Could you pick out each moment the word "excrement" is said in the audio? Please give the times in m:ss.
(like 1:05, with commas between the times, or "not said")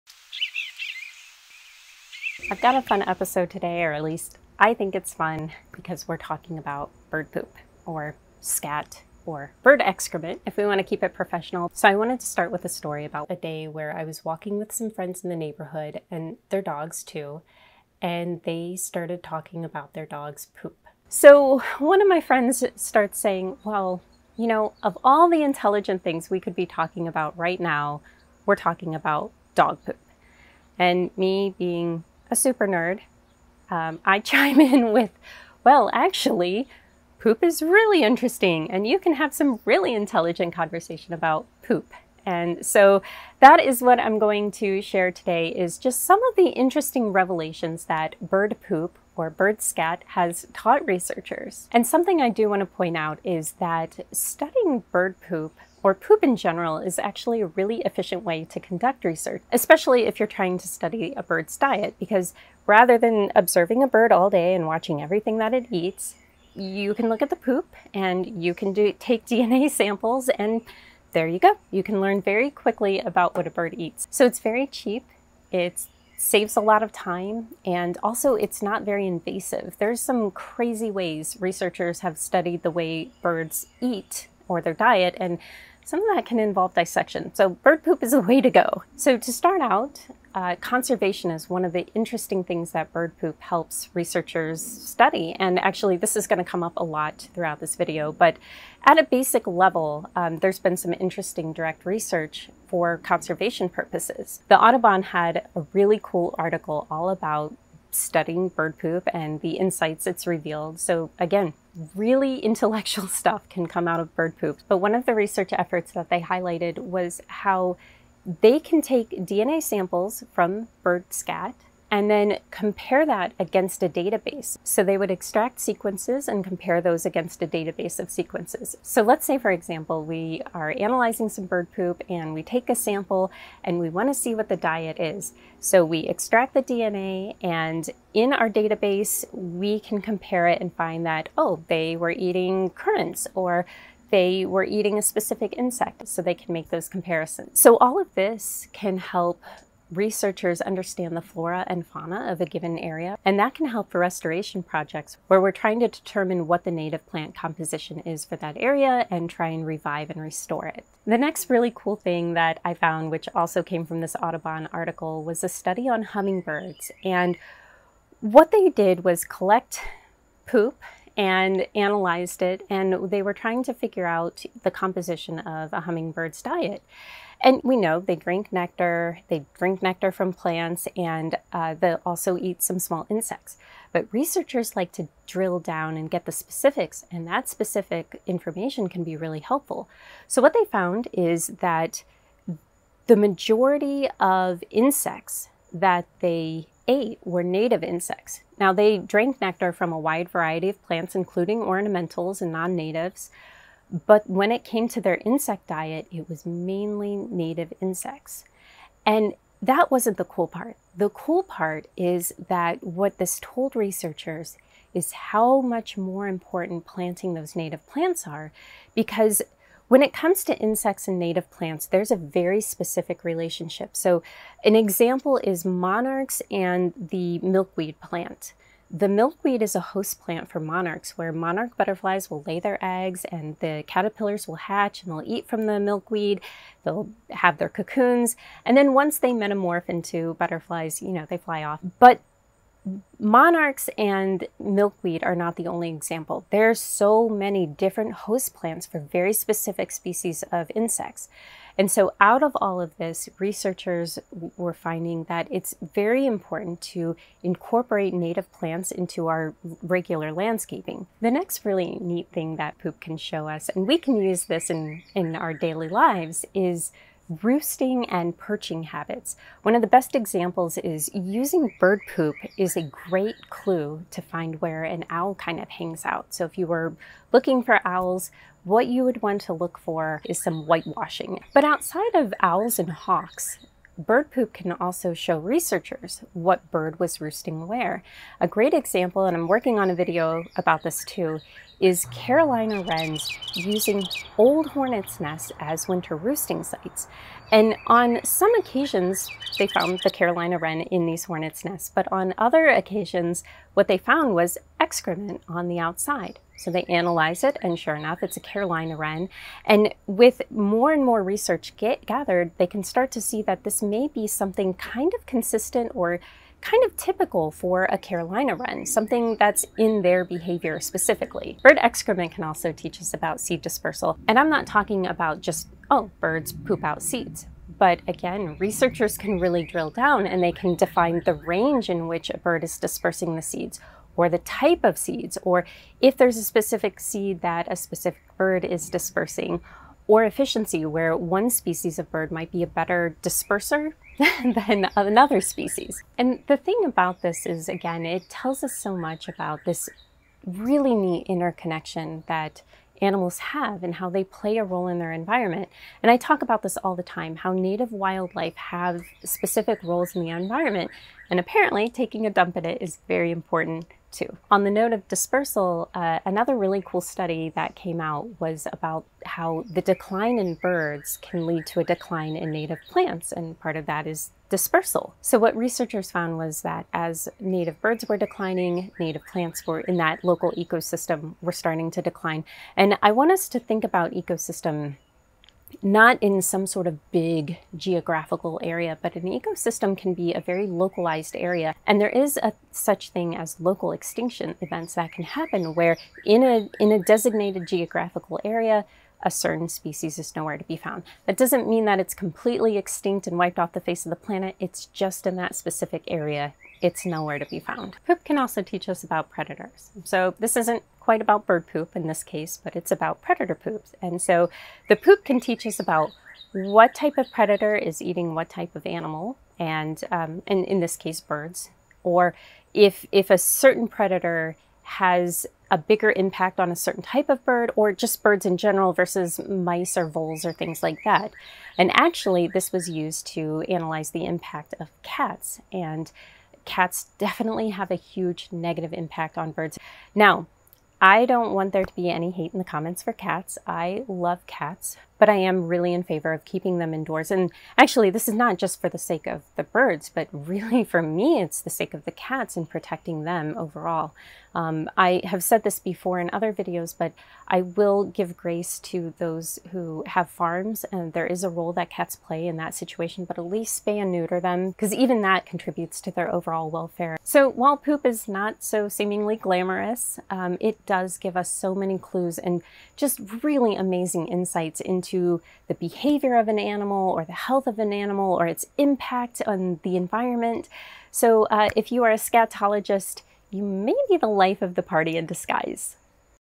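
0:09, 5:04, 5:21.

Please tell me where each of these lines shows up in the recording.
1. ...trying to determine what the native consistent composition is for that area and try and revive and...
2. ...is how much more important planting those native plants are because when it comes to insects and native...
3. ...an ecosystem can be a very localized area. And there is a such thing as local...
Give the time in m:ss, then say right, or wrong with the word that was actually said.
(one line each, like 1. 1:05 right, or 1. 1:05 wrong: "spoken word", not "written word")
1. 2:35 wrong: "plant", not "consistent"
2. 3:34 right
3. 6:29 right.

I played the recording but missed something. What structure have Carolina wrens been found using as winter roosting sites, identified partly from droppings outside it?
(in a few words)
Old hornets' nests.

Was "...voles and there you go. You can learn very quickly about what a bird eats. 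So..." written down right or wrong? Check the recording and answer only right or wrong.
wrong.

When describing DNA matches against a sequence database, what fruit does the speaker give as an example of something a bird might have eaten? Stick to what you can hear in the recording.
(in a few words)
Currants.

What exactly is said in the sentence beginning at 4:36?
So if you were looking for owls, what you would want to look for is some whitewashing.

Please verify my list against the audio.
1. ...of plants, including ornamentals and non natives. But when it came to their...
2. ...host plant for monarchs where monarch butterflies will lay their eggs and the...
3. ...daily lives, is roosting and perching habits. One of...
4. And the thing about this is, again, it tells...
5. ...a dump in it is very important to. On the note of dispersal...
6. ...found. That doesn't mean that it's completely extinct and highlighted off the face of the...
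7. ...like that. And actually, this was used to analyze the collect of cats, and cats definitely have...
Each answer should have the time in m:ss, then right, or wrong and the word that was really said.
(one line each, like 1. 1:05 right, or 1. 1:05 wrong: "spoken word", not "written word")
1. 3:20 right
2. 3:49 right
3. 4:25 right
4. 5:46 right
5. 6:02 right
6. 6:40 wrong: "wiped", not "highlighted"
7. 7:10 wrong: "impact", not "collect".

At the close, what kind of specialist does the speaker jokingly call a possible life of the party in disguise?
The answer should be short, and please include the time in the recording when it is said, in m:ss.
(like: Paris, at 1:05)
Scatologist, at 8:02.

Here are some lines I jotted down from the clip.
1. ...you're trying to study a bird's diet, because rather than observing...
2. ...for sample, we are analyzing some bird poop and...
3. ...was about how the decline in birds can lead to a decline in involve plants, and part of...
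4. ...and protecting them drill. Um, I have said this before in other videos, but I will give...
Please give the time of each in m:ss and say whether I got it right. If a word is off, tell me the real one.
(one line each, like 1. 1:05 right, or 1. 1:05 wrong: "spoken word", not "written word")
1. 1:00 right
2. 2:09 wrong: "example", not "sample"
3. 6:08 wrong: "native", not "involve"
4. 7:32 wrong: "overall", not "drill".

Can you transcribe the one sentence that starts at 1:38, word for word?
But at a basic level, um, there's been some interesting direct research for conservation purposes.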